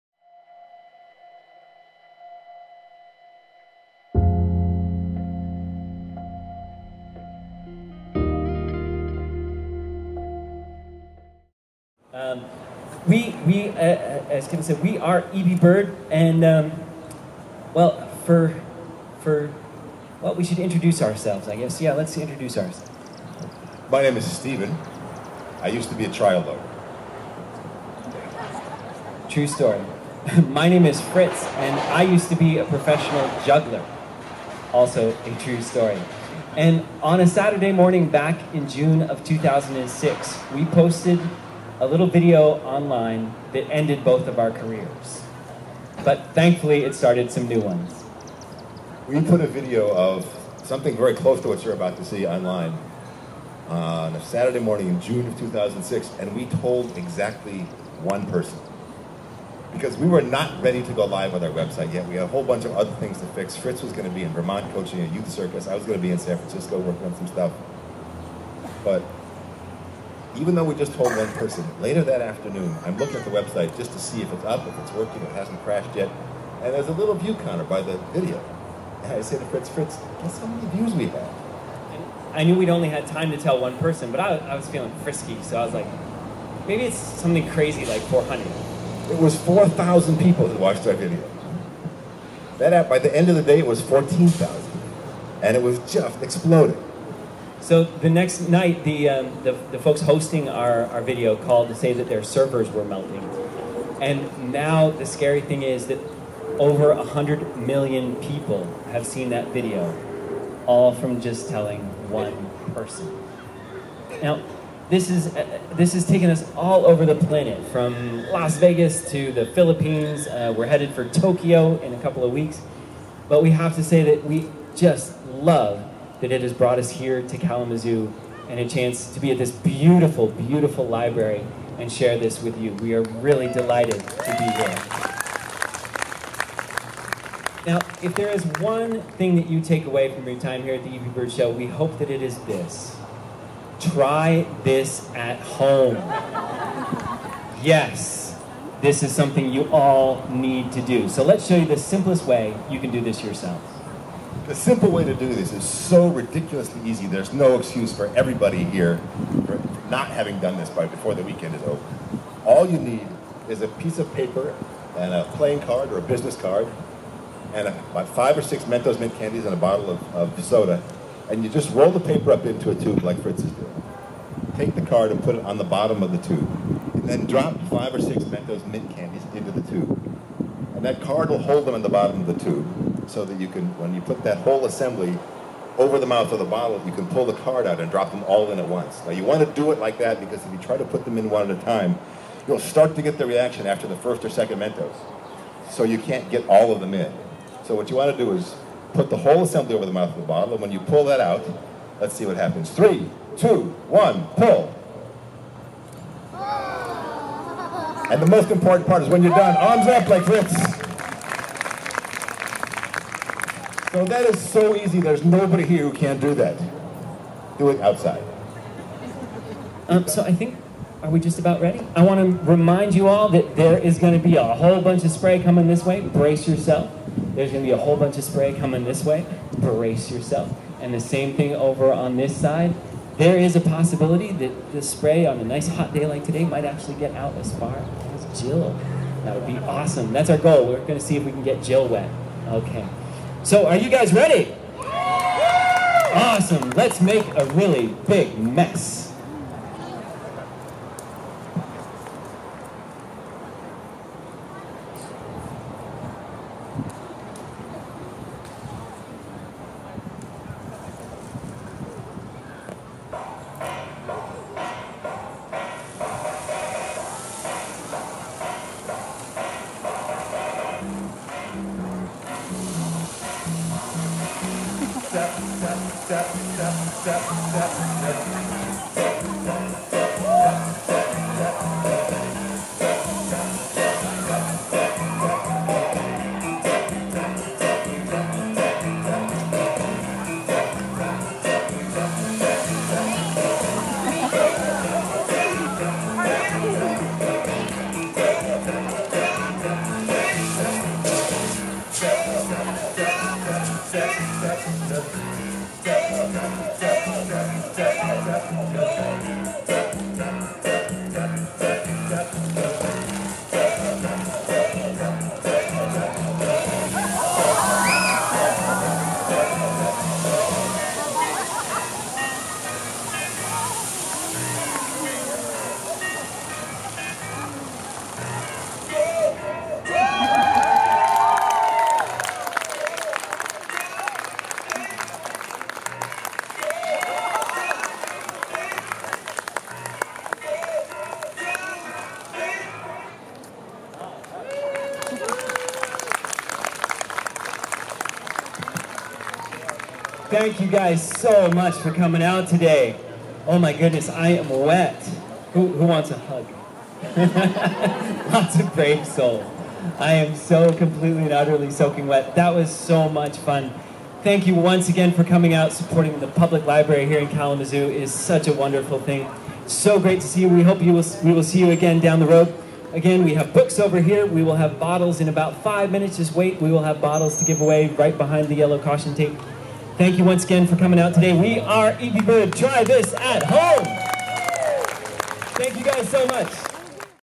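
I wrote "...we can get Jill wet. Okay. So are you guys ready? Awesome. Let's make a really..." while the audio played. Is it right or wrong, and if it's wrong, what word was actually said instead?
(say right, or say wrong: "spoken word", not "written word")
right.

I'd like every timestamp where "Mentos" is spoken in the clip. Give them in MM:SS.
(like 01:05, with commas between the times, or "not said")
02:48, 02:58, 03:14.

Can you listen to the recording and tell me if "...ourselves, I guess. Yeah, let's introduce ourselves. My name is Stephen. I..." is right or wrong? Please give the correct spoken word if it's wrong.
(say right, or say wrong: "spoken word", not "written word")
right.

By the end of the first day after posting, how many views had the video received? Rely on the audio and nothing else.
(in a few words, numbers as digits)
14,000.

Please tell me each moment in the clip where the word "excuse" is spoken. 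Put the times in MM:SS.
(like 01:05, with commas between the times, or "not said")
02:37.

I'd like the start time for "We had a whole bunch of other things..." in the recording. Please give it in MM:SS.
01:02.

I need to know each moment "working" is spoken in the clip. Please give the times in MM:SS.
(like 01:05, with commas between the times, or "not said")
01:06, 01:14.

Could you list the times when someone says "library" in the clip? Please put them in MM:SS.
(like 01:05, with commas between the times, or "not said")
02:10, 06:06.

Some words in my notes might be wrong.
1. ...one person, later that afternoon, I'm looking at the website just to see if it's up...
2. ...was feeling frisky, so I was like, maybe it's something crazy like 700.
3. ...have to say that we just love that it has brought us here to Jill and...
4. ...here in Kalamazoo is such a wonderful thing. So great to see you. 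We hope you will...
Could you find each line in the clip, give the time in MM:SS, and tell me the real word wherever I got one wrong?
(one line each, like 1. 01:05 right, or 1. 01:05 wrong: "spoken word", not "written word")
1. 01:11 right
2. 01:24 wrong: "400", not "700"
3. 02:03 wrong: "Kalamazoo", not "Jill"
4. 06:07 right.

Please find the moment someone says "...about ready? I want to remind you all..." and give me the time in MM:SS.
03:41.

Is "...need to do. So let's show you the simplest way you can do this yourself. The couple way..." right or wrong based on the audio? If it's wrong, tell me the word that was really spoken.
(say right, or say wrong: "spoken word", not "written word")
wrong: "simple", not "couple".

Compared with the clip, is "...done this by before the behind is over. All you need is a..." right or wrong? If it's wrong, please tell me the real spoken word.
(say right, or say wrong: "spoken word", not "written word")
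wrong: "weekend", not "behind".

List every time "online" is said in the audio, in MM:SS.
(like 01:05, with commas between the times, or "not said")
00:42, 00:52.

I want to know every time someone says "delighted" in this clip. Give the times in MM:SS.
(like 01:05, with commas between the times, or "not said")
02:13.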